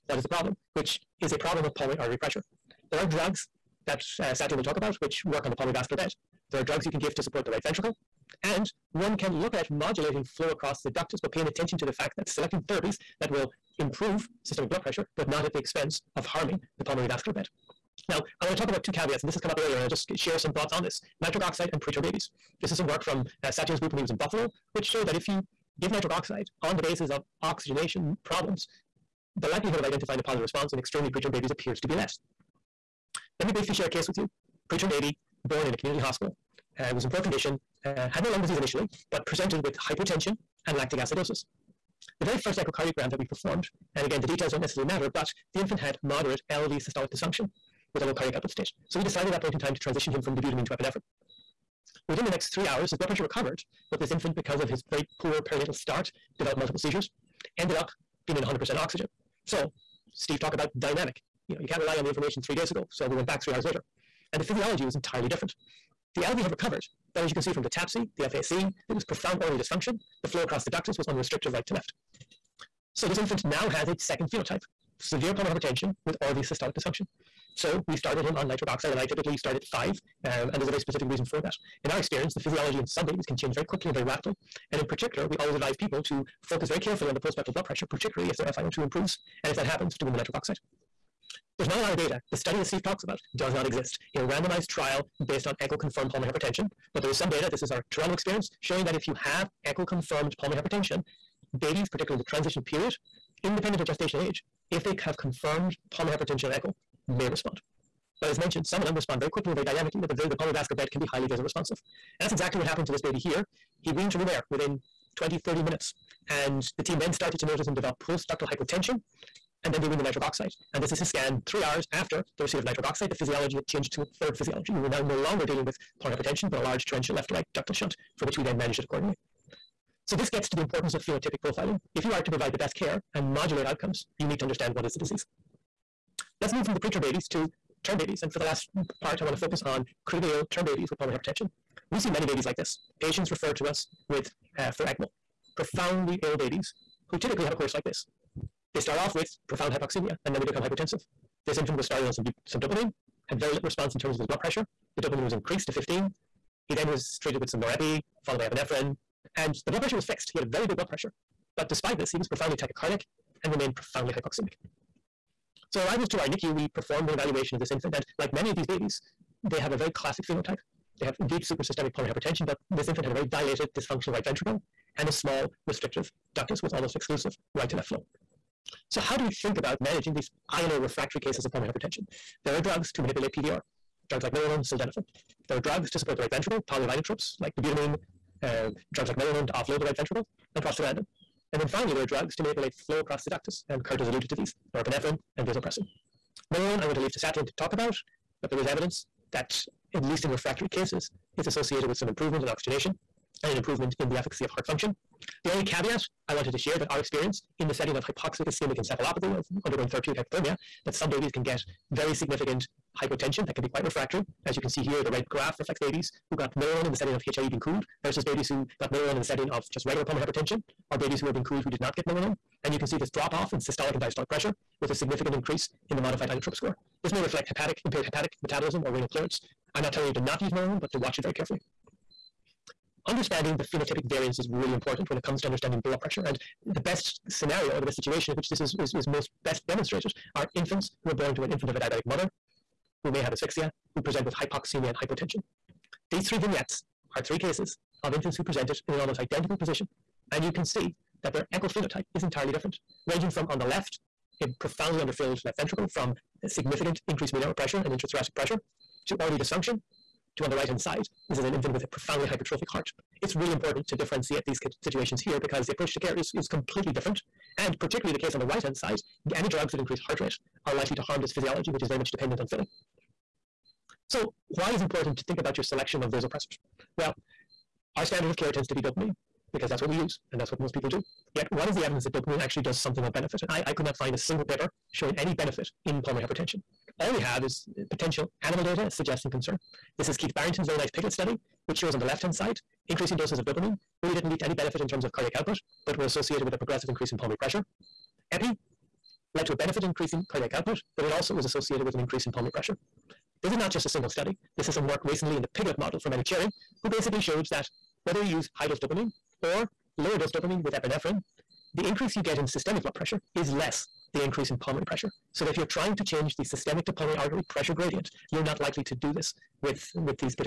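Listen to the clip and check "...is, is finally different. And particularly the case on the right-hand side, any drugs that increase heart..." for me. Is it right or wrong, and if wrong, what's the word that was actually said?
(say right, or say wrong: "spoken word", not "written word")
wrong: "completely", not "finally".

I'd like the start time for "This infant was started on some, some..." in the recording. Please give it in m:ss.
2:31.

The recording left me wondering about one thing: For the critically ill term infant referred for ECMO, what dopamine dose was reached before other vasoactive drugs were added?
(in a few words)
15.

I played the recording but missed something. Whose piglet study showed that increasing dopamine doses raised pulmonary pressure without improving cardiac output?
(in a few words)
Keith Barrington.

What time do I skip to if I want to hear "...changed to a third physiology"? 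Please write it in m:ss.
2:03.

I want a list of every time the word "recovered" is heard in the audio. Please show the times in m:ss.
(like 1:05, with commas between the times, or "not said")
0:53, 1:06.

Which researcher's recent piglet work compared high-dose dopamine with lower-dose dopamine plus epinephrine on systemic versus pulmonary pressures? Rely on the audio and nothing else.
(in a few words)
Manouchehri.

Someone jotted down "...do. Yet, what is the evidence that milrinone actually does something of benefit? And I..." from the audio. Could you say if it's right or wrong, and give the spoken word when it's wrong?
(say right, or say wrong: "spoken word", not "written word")
wrong: "dopamine", not "milrinone".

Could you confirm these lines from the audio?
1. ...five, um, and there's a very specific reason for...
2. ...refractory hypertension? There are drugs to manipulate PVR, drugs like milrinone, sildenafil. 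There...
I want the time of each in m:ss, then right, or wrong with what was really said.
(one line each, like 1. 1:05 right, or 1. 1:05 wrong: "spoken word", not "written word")
1. 1:19 right
2. 3:01 wrong: "pulmonary", not "refractory".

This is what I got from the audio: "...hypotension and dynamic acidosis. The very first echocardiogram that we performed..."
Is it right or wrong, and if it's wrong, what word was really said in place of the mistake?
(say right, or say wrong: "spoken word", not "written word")
wrong: "lactic", not "dynamic".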